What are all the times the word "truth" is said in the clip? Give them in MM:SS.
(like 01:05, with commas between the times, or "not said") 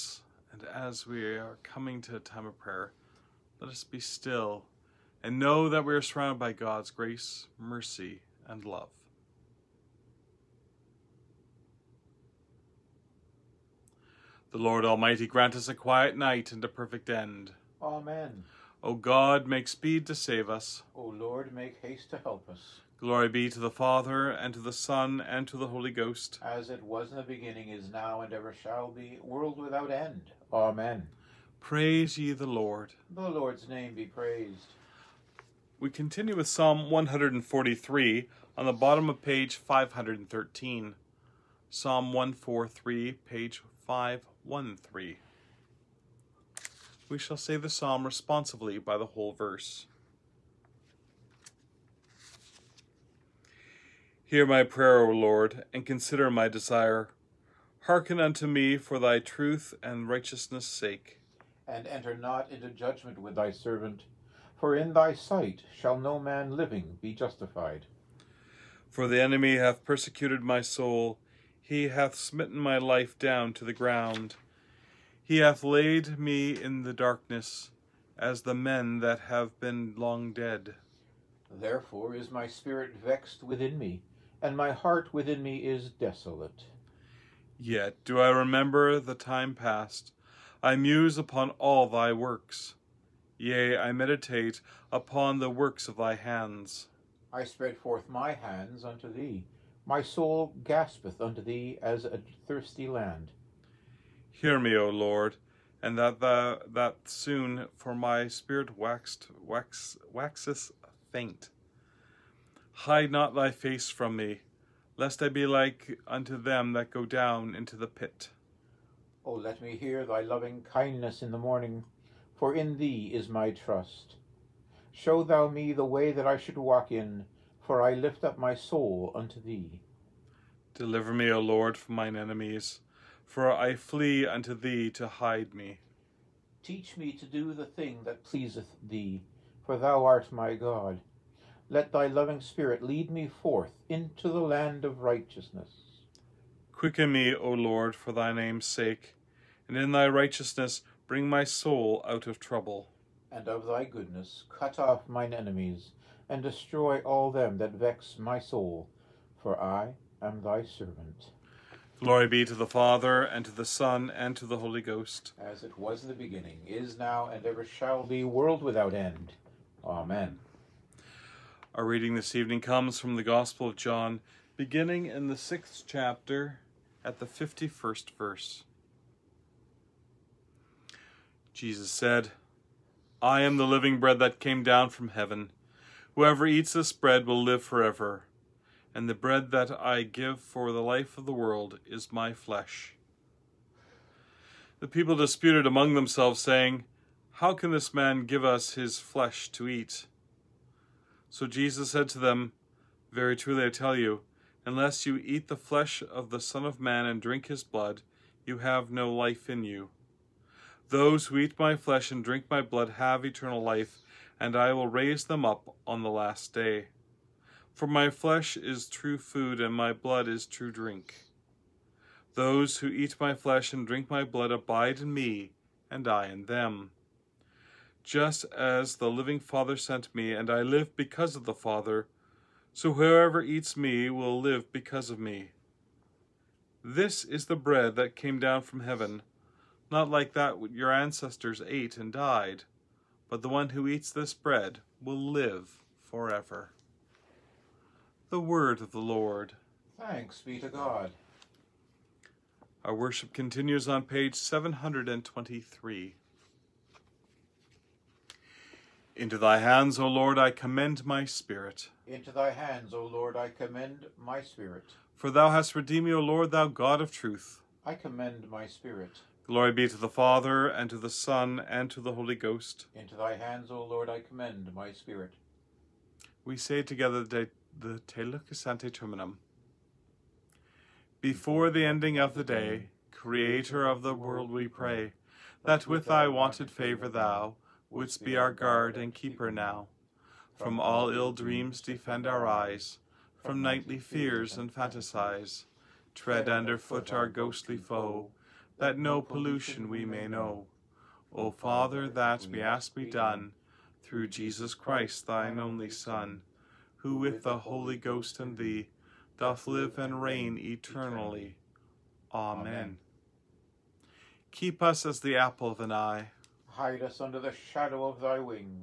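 00:59, 04:27.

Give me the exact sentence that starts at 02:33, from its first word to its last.
And of thy goodness cut off mine enemies, and destroy all them that vex my soul, for I am thy servant.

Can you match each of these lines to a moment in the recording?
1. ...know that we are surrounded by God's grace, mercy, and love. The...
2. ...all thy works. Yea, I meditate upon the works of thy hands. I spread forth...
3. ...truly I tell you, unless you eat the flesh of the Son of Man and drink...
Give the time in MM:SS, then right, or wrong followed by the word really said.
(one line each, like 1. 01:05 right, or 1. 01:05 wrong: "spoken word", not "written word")
1. 00:05 right
2. 01:31 right
3. 03:23 right.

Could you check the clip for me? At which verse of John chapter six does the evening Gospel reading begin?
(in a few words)
51.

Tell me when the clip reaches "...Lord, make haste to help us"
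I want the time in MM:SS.
00:21.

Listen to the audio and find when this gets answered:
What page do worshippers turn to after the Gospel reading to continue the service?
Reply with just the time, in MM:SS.
04:14.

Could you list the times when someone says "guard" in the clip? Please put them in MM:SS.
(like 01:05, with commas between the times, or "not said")
04:48.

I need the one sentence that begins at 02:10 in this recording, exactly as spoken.
Deliver me, O Lord, from mine enemies, for I flee unto thee to hide me.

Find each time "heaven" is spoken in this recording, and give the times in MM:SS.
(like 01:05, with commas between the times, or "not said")
03:05, 03:58.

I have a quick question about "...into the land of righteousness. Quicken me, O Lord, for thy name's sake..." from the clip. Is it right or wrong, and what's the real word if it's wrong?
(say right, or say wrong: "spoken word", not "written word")
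right.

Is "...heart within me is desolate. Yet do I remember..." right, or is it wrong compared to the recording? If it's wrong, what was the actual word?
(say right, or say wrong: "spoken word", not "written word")
right.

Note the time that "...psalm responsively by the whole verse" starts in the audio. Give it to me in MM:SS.
00:47.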